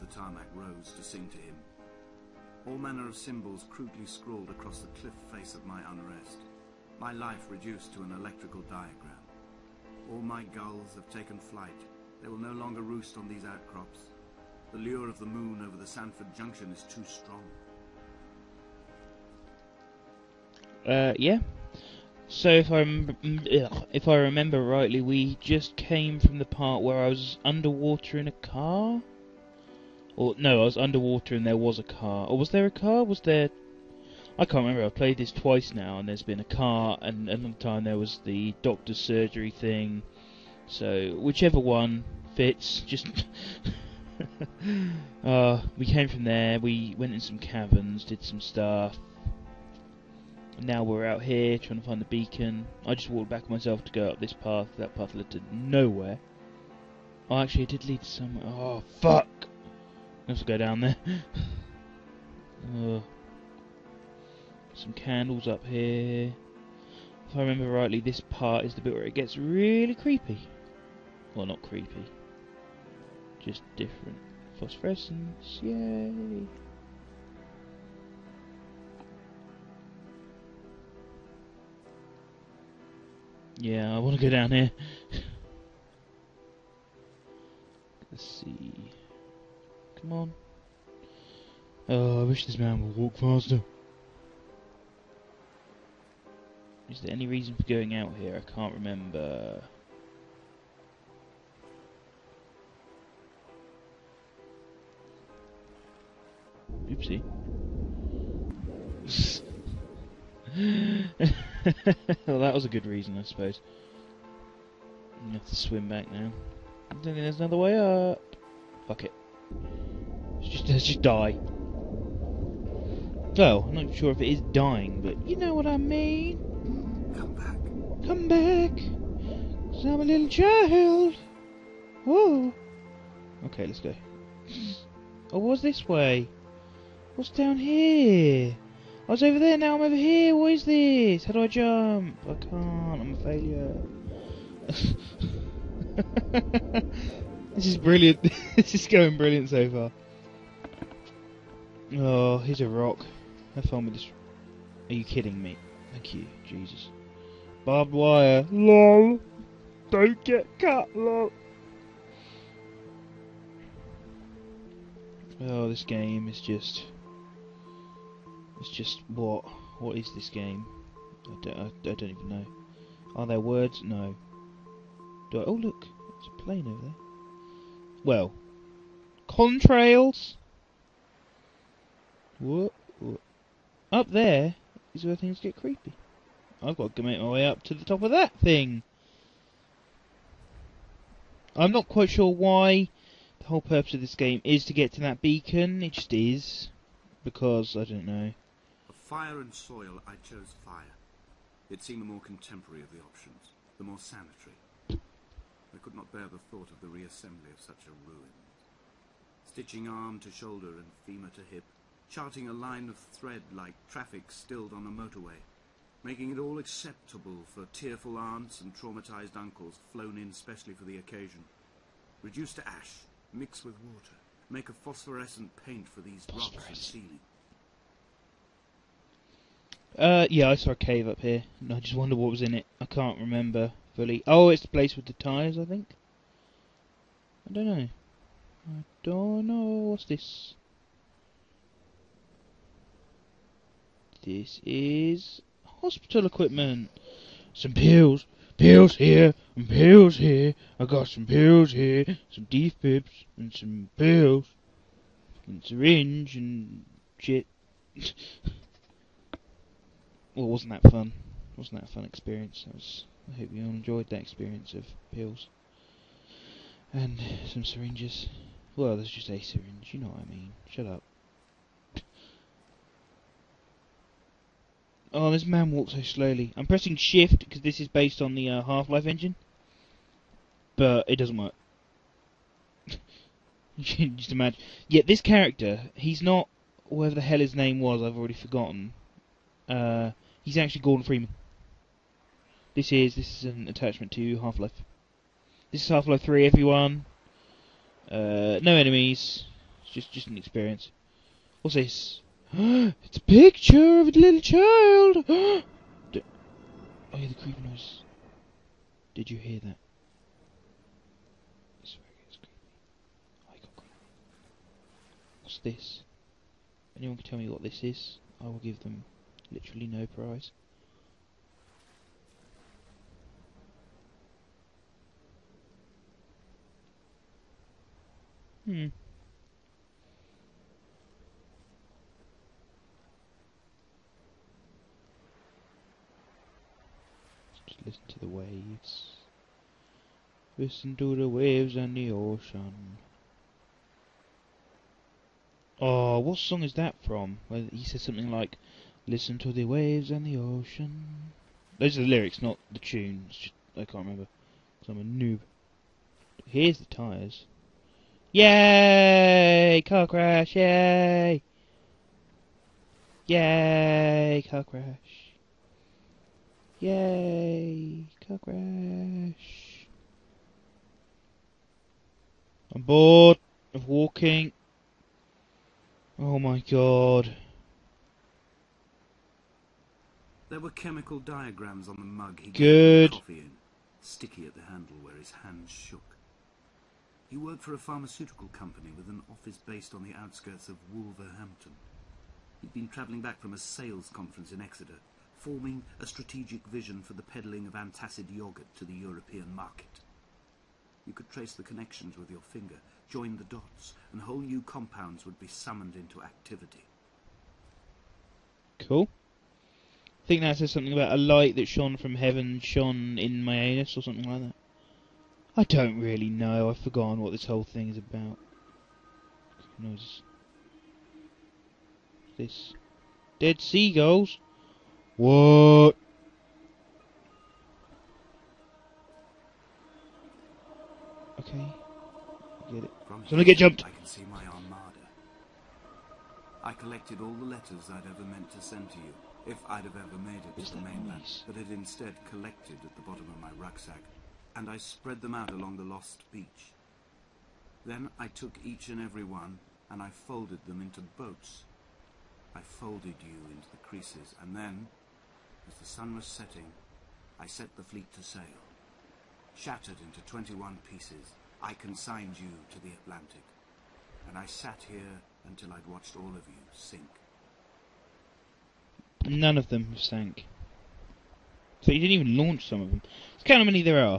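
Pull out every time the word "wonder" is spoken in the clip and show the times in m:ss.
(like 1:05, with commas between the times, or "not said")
3:51.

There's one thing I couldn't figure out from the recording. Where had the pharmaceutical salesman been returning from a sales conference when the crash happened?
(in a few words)
Exeter.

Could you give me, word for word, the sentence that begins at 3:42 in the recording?
Reduce to ash, mix with water, make a phosphorescent paint for these rocks and ceiling.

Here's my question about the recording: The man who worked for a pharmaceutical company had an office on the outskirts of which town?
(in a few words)
Wolverhampton.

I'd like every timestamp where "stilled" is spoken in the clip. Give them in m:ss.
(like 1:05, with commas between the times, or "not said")
3:34.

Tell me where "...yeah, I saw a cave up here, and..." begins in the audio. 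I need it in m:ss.
3:50.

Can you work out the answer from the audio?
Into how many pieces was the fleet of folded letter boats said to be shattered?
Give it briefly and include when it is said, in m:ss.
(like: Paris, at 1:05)
21, at 7:40.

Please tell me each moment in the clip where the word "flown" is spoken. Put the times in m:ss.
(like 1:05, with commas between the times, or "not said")
3:39.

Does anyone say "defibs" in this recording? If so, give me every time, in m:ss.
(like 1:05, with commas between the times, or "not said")
4:12.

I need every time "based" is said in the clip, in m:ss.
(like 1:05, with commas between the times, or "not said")
4:37, 6:29.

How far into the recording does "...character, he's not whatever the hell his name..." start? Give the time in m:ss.
4:45.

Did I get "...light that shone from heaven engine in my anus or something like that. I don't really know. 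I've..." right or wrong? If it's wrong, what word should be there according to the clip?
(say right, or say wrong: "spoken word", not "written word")
wrong: "shone", not "engine".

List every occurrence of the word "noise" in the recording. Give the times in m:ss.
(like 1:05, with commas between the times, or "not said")
5:07, 6:59.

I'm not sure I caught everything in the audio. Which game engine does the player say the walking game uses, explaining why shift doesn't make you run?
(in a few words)
Half-Life engine.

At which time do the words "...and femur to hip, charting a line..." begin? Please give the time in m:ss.
3:30.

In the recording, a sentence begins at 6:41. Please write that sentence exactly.
You could trace the connections with your finger, join the dots, and whole new compounds would be summoned into activity.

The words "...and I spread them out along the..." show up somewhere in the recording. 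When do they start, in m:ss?
7:24.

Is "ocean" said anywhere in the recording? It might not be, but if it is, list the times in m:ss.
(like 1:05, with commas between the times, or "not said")
5:42, 5:50.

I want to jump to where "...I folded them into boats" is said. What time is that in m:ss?
7:30.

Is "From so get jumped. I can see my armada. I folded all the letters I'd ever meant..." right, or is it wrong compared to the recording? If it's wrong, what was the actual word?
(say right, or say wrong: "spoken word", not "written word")
wrong: "collected", not "folded".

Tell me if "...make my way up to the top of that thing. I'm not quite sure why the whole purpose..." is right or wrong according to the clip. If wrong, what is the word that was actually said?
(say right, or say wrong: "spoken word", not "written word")
right.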